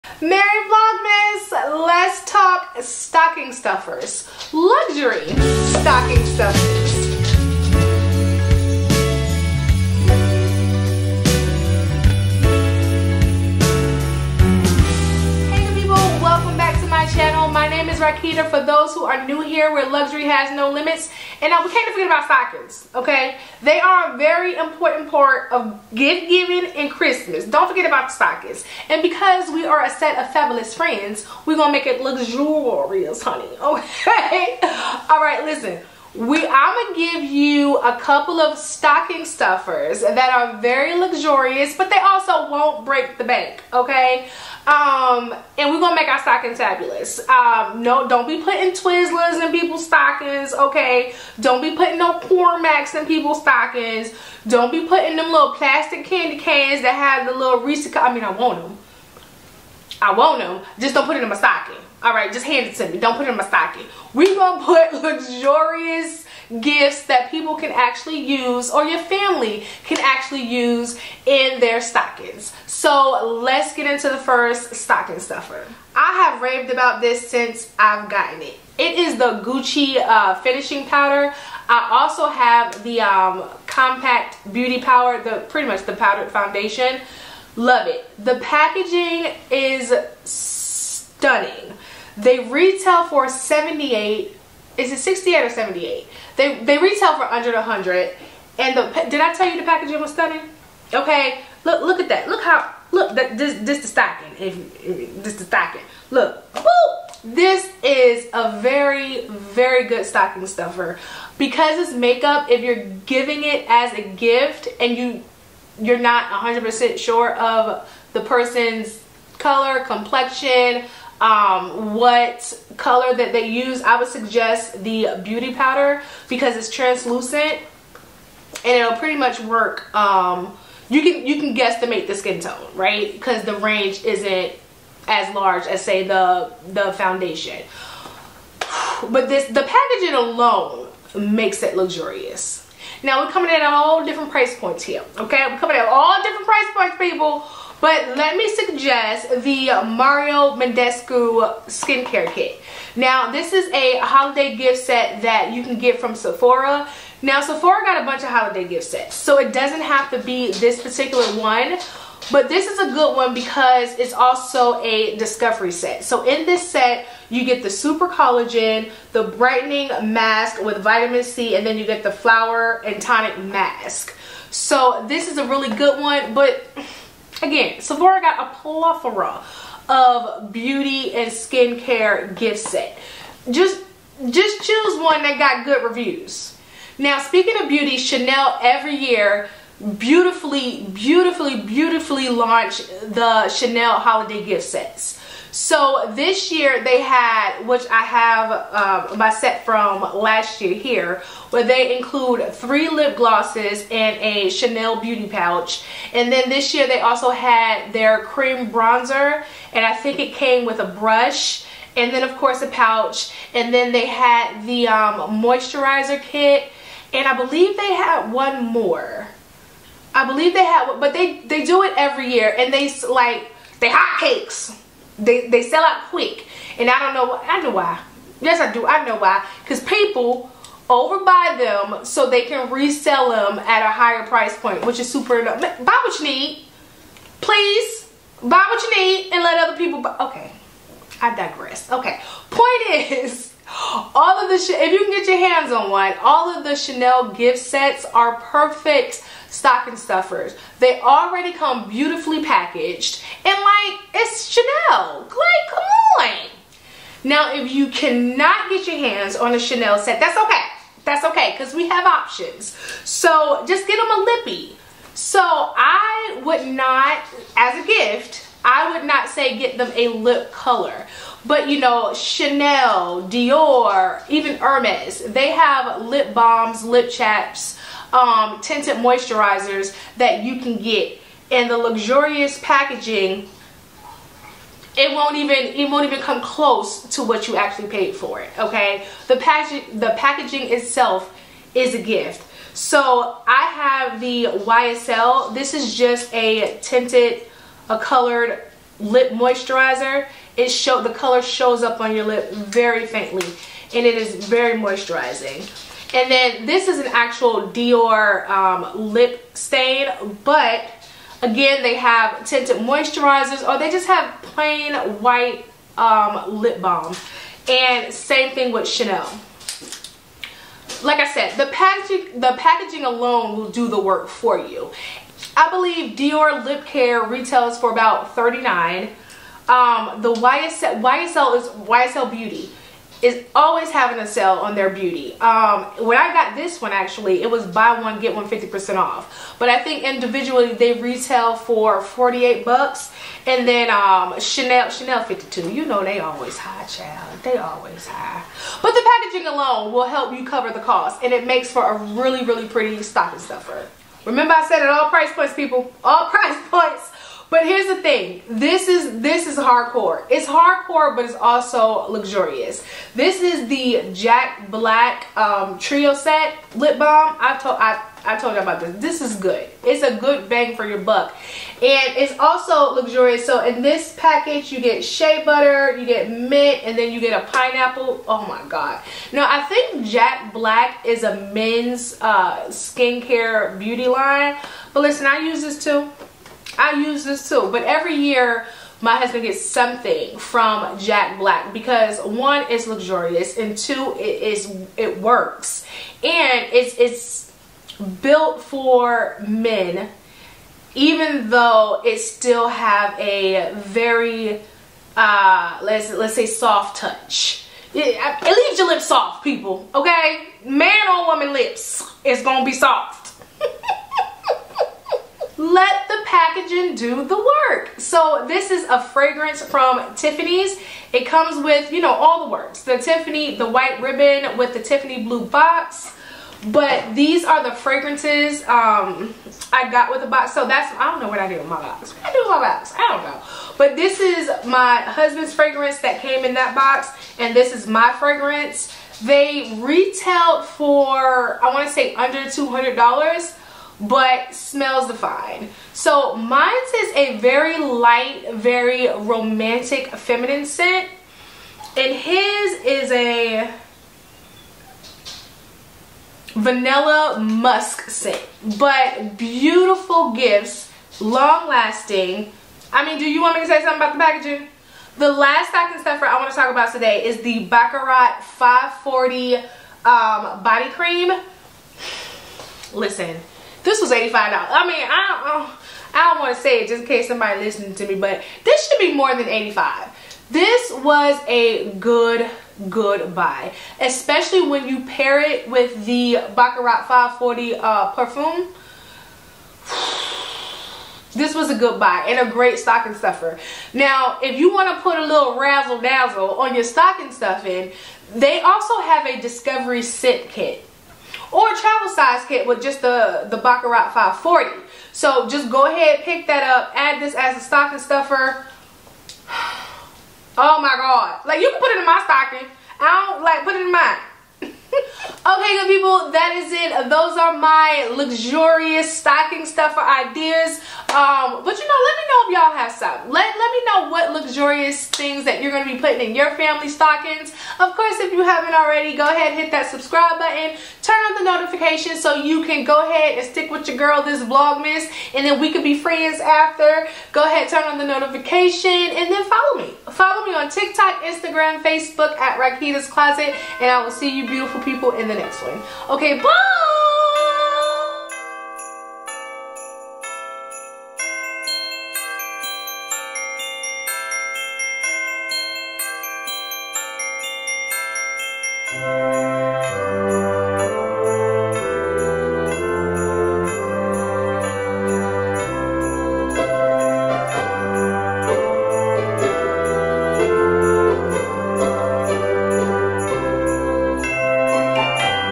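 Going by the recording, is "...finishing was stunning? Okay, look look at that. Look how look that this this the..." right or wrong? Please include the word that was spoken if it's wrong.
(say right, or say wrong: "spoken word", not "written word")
wrong: "packaging", not "finishing".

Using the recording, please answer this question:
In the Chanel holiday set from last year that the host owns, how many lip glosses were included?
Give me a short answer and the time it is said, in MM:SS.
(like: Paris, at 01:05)
3, at 03:22.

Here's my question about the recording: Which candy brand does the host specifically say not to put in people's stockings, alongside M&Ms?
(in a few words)
Twizzlers.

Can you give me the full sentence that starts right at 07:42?
I mean, do you want me to say something about the packaging?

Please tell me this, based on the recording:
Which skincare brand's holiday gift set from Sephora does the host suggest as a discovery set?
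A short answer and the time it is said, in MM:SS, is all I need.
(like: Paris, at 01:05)
Mario Badescu, at 02:29.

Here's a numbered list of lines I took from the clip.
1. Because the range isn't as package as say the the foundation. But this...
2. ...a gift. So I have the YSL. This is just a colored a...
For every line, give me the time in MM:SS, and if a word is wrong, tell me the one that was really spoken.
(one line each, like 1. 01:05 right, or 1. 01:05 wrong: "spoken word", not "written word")
1. 02:13 wrong: "large", not "package"
2. 04:51 wrong: "tinted", not "colored".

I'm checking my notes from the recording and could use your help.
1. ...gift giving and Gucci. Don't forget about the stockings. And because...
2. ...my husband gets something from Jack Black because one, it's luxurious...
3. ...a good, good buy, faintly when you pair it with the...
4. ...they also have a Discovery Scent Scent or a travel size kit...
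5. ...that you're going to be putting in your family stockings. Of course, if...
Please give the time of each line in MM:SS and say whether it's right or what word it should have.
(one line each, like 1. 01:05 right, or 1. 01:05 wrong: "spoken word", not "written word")
1. 00:25 wrong: "Christmas", not "Gucci"
2. 06:29 right
3. 08:01 wrong: "especially", not "faintly"
4. 08:18 wrong: "Kit", not "Scent"
5. 08:45 right.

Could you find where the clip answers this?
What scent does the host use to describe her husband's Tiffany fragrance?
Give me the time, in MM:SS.
07:36.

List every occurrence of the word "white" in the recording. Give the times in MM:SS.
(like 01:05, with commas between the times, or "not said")
05:15, 07:03.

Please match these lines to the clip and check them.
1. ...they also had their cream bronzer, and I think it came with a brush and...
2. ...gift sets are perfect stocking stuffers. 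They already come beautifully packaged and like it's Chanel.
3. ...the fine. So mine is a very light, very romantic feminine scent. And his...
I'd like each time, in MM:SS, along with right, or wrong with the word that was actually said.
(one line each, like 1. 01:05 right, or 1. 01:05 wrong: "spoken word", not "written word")
1. 03:26 right
2. 04:07 right
3. 07:25 right.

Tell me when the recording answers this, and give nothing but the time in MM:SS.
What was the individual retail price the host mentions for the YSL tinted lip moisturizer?
05:42.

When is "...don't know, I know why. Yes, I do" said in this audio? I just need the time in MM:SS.
03:46.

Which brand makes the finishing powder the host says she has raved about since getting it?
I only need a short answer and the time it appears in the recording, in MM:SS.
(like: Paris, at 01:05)
Gucci, at 01:19.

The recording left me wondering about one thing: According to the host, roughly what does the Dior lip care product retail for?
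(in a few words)
$39.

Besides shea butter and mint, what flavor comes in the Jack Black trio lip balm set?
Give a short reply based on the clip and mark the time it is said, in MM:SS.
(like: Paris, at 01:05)
Pineapple, at 06:17.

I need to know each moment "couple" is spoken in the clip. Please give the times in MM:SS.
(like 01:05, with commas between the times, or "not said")
00:37.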